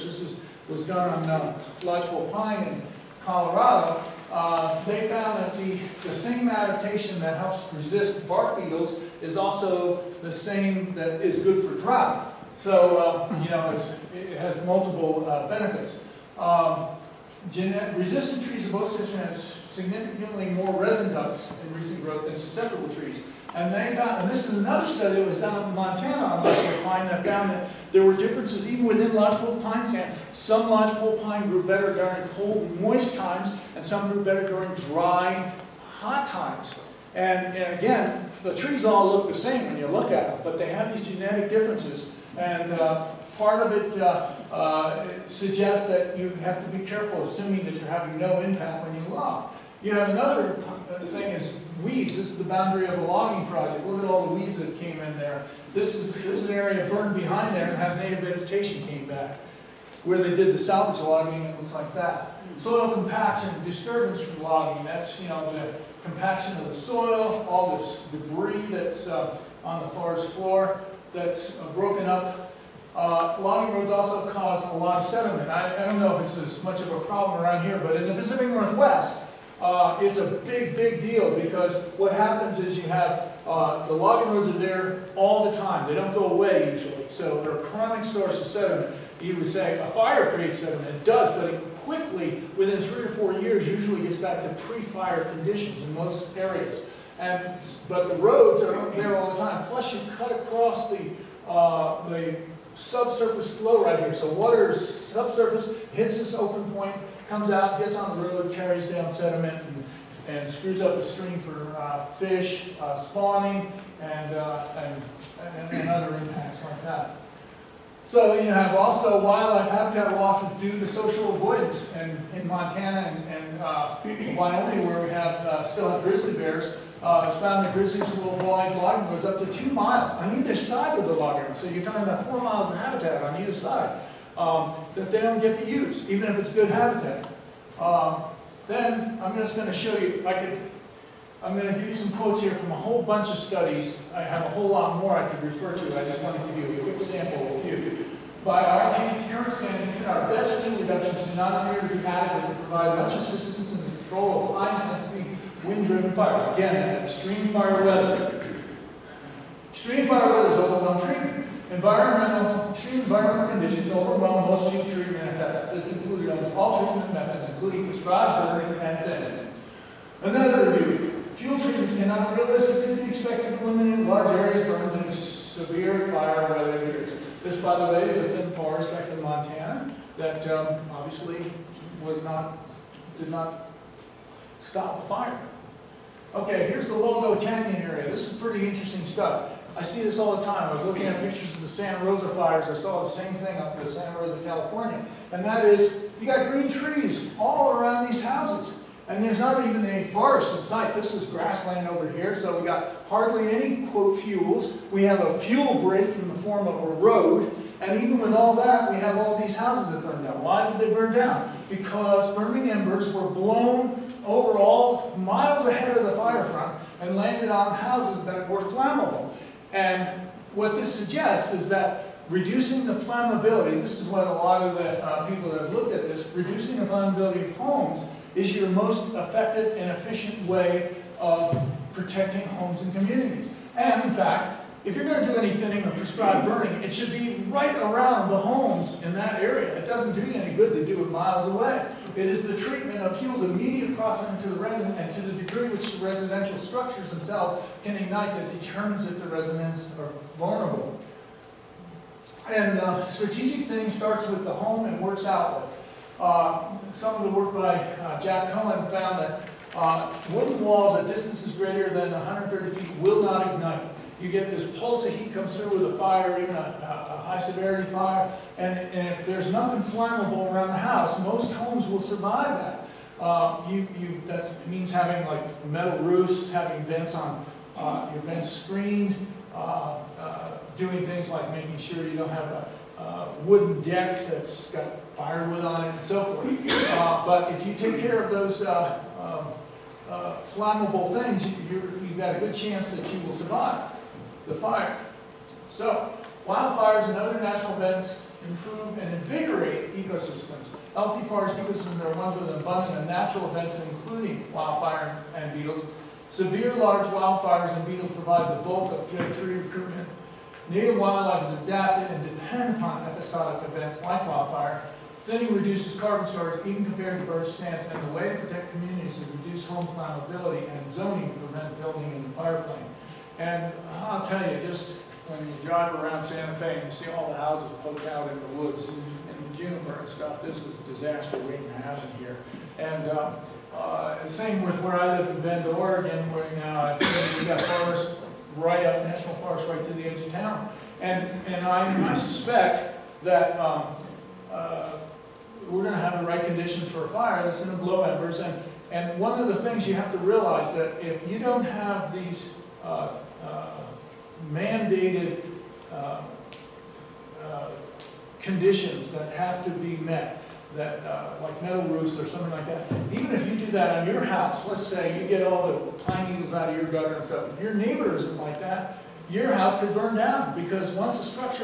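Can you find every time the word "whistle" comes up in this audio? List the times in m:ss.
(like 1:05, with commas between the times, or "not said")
not said.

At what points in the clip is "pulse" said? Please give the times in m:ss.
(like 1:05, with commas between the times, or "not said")
4:24.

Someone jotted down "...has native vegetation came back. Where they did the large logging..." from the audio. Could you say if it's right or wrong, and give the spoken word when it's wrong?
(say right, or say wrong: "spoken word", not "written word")
wrong: "salvage", not "large".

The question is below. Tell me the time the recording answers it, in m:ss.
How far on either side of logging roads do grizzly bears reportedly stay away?
2:09.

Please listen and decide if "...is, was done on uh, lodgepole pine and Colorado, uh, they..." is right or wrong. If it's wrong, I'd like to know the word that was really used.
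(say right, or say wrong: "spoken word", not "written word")
right.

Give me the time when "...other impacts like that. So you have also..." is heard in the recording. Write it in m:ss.
1:55.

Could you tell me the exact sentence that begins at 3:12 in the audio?
I saw the same thing up in Santa Rosa, California.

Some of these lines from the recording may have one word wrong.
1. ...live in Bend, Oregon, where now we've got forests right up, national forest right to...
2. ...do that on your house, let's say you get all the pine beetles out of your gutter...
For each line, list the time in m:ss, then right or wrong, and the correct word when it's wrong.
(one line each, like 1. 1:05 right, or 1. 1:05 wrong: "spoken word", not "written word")
1. 5:35 right
2. 6:03 wrong: "needles", not "beetles".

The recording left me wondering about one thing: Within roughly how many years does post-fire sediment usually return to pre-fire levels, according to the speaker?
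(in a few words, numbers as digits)
3 or 4 years.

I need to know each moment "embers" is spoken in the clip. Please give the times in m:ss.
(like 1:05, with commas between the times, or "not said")
3:32, 5:48.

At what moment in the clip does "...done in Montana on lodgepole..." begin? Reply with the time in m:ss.
0:25.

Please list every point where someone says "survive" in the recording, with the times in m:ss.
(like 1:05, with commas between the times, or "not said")
4:32, 4:53.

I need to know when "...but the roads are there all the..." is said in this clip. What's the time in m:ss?
1:37.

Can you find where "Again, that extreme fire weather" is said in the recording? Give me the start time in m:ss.
2:36.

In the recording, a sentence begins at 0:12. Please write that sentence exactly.
So, uh, you know, it has multiple uh, benefits.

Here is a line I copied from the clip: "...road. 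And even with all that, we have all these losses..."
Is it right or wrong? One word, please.
wrong.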